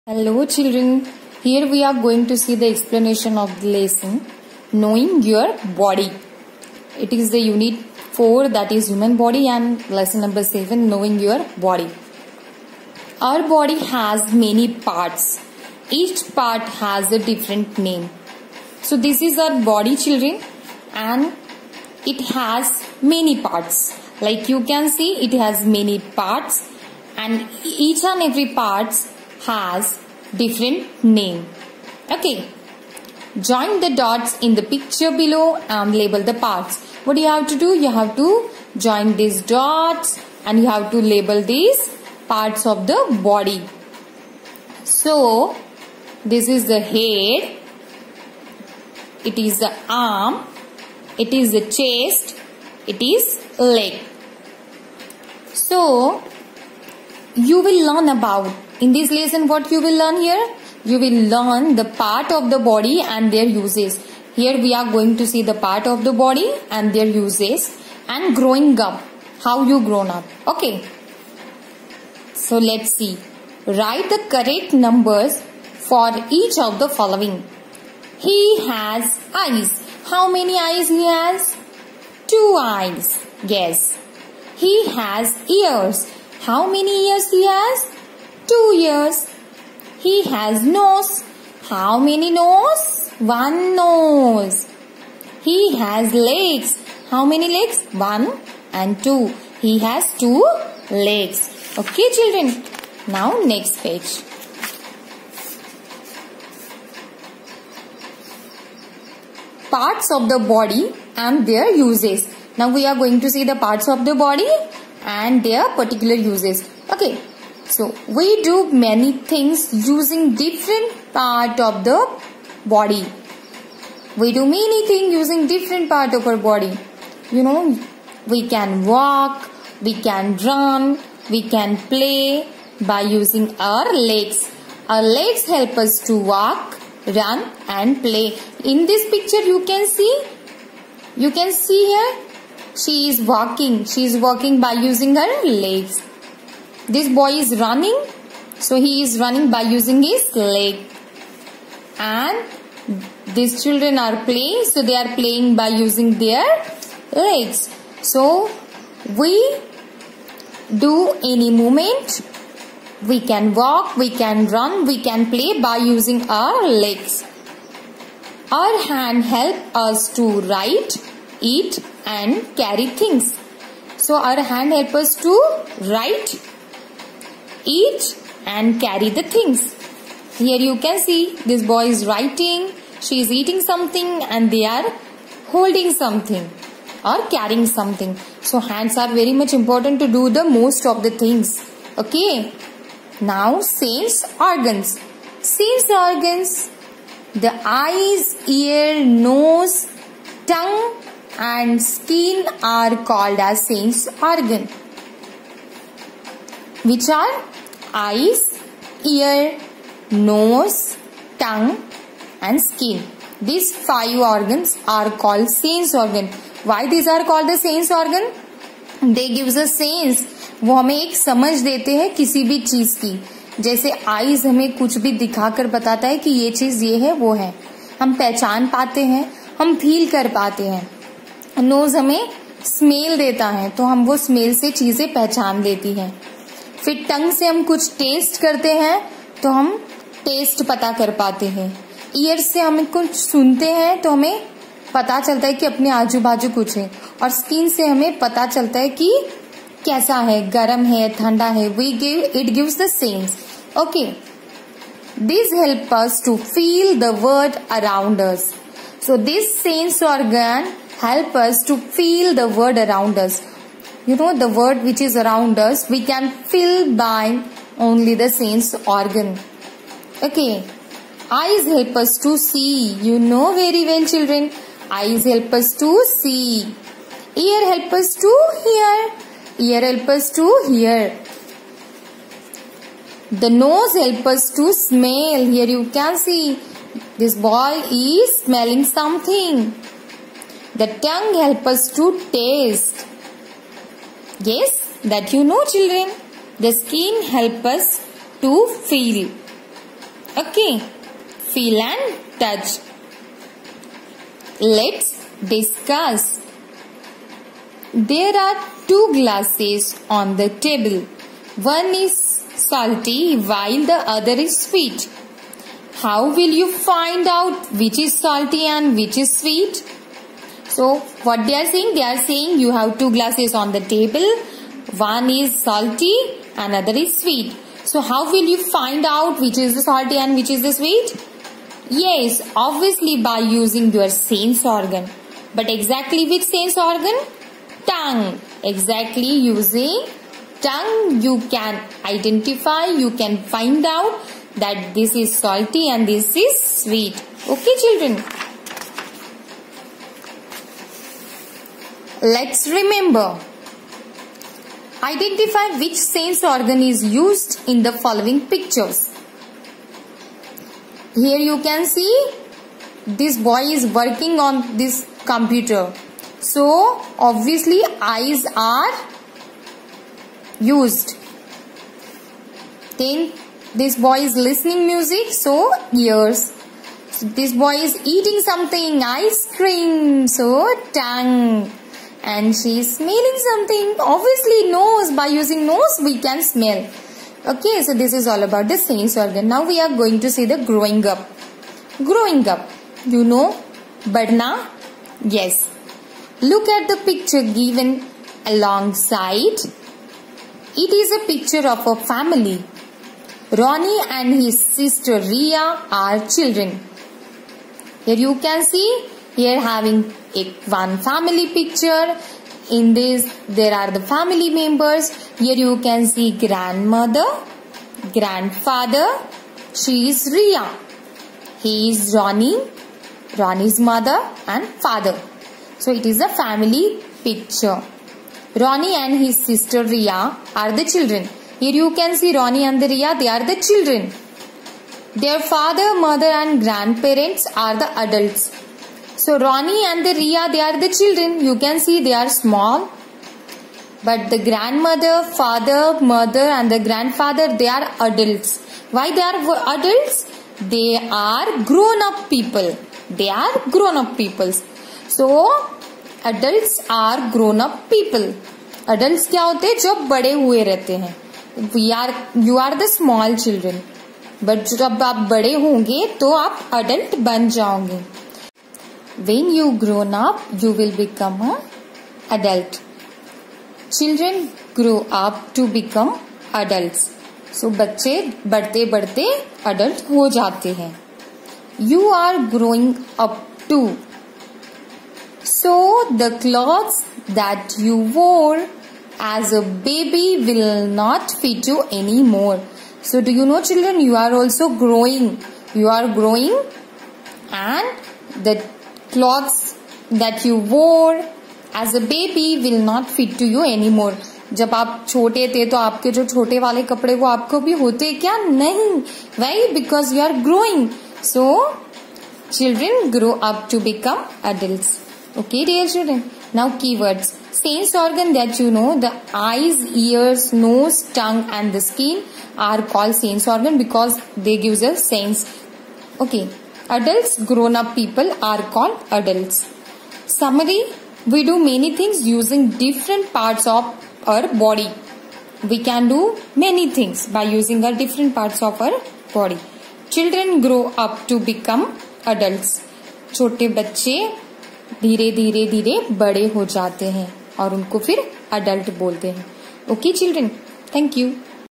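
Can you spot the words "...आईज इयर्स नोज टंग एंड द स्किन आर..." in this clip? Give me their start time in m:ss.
8:39.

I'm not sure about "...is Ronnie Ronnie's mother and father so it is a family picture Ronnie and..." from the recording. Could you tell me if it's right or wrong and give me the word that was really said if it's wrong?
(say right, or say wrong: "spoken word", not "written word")
right.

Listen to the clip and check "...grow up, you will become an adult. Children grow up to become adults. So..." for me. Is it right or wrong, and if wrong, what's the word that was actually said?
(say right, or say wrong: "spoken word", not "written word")
right.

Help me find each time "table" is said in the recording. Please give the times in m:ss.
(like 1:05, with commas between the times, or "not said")
5:10, 5:23.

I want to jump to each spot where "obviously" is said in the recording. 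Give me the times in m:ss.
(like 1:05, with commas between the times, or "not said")
5:32, 6:07, 6:23.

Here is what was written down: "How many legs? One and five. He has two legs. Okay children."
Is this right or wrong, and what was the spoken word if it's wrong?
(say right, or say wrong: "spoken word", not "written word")
wrong: "two", not "five".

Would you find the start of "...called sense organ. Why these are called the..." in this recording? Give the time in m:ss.
3:35.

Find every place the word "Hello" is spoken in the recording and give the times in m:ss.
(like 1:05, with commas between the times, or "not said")
0:00.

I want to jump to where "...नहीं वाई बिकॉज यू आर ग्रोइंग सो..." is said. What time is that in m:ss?
8:28.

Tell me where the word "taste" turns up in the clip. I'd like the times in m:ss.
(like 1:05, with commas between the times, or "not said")
4:52.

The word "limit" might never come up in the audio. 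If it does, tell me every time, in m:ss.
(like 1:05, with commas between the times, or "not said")
not said.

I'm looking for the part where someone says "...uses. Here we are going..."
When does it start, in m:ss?
1:03.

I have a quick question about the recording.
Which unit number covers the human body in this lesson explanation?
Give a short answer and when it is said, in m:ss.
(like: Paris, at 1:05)
4, at 0:07.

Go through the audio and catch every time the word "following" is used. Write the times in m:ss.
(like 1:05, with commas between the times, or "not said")
1:16, 5:57.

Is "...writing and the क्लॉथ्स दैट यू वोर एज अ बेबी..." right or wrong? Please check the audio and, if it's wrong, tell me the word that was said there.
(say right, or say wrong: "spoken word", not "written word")
wrong: "growing", not "writing".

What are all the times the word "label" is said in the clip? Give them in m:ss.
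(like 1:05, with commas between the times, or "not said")
0:35, 0:40.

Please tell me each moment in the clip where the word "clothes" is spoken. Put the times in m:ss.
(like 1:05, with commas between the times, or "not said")
8:06.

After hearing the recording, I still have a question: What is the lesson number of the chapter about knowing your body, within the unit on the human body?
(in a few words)
7.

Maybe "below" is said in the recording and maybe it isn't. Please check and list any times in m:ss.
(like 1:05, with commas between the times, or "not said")
0:35.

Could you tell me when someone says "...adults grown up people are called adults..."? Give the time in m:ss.
8:46.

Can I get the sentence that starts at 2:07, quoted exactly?
You know, we can walk, we can run, we can play by using our legs.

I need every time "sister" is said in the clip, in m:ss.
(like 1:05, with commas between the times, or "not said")
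6:44, 7:09.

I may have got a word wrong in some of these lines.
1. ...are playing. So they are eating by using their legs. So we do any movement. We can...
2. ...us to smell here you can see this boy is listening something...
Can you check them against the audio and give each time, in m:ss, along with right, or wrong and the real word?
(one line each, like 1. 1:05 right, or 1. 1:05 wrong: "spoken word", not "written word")
1. 2:33 wrong: "playing", not "eating"
2. 4:44 wrong: "smelling", not "listening".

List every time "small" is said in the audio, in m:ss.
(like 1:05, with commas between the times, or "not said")
7:22, 7:42.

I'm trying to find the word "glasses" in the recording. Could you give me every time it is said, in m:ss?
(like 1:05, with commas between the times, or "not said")
5:09, 5:23.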